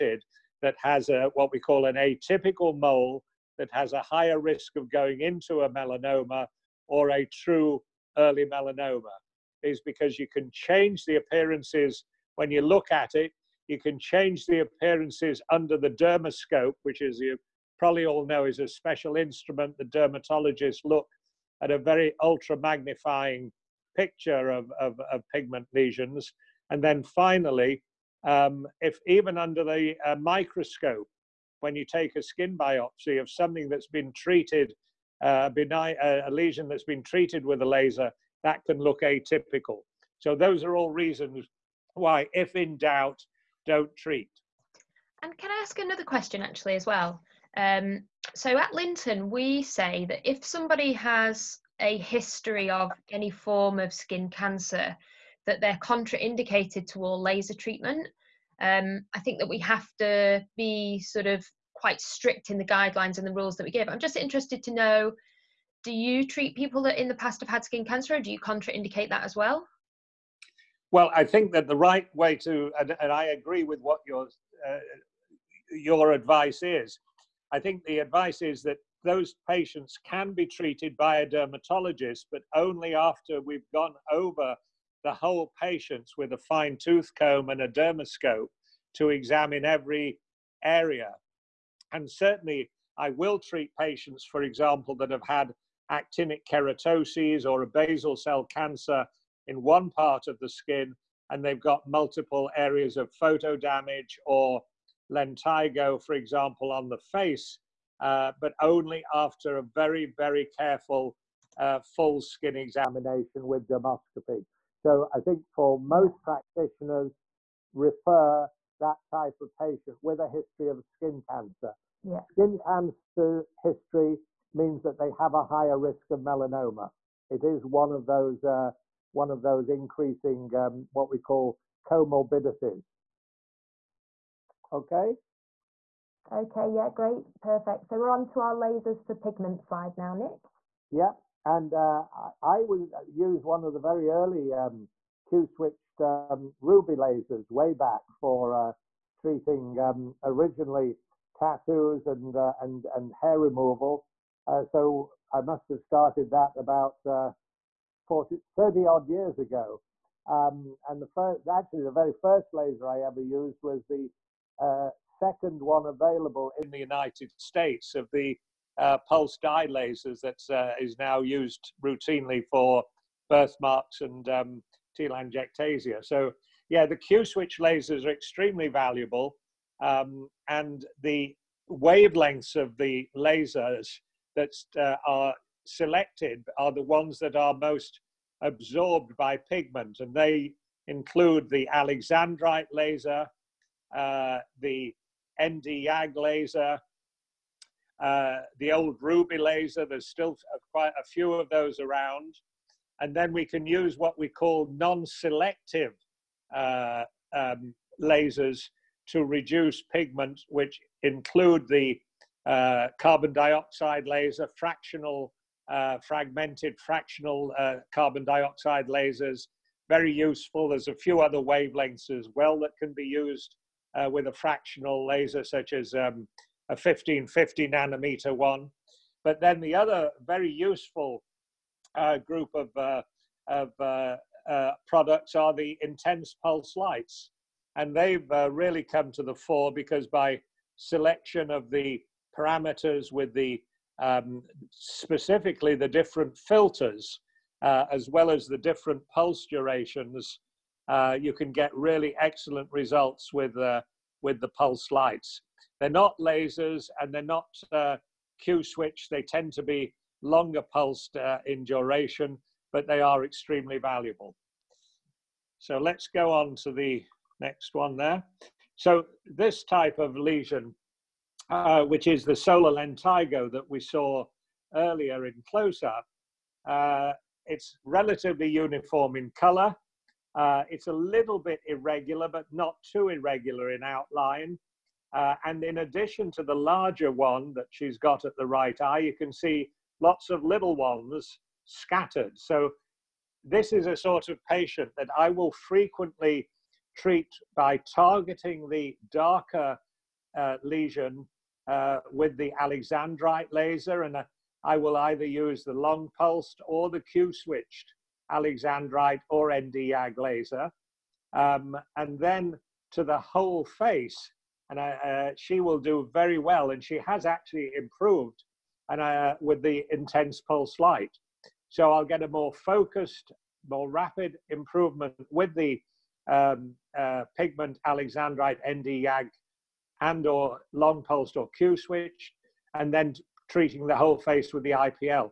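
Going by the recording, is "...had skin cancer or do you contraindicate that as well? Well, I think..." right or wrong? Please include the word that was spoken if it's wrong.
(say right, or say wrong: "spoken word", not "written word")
right.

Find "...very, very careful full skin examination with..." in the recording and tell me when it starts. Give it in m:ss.
1:49.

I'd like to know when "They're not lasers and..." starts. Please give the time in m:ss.
4:15.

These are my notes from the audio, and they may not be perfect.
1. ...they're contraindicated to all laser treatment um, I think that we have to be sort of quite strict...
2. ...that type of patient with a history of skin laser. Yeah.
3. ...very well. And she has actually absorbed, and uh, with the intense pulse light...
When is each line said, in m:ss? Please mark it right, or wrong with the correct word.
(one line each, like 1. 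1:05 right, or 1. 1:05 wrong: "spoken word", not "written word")
1. 0:55 right
2. 1:58 wrong: "cancer", not "laser"
3. 5:16 wrong: "improved", not "absorbed".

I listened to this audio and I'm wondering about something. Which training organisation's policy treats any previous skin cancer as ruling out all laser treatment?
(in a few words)
Lynton.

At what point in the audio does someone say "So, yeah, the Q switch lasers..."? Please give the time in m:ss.
2:56.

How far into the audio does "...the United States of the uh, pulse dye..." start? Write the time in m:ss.
2:46.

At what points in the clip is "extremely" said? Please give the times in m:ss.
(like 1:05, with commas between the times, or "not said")
2:58, 4:23.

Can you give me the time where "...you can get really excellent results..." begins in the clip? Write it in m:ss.
4:11.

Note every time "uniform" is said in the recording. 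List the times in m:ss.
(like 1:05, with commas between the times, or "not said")
4:38.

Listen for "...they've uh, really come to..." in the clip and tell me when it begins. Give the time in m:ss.
3:57.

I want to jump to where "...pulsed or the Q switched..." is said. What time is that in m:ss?
5:06.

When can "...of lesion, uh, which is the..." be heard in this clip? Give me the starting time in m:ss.
4:29.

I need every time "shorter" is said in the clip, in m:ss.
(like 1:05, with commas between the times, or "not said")
not said.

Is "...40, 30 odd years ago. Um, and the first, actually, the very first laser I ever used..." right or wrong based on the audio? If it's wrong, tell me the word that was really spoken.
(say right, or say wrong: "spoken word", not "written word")
right.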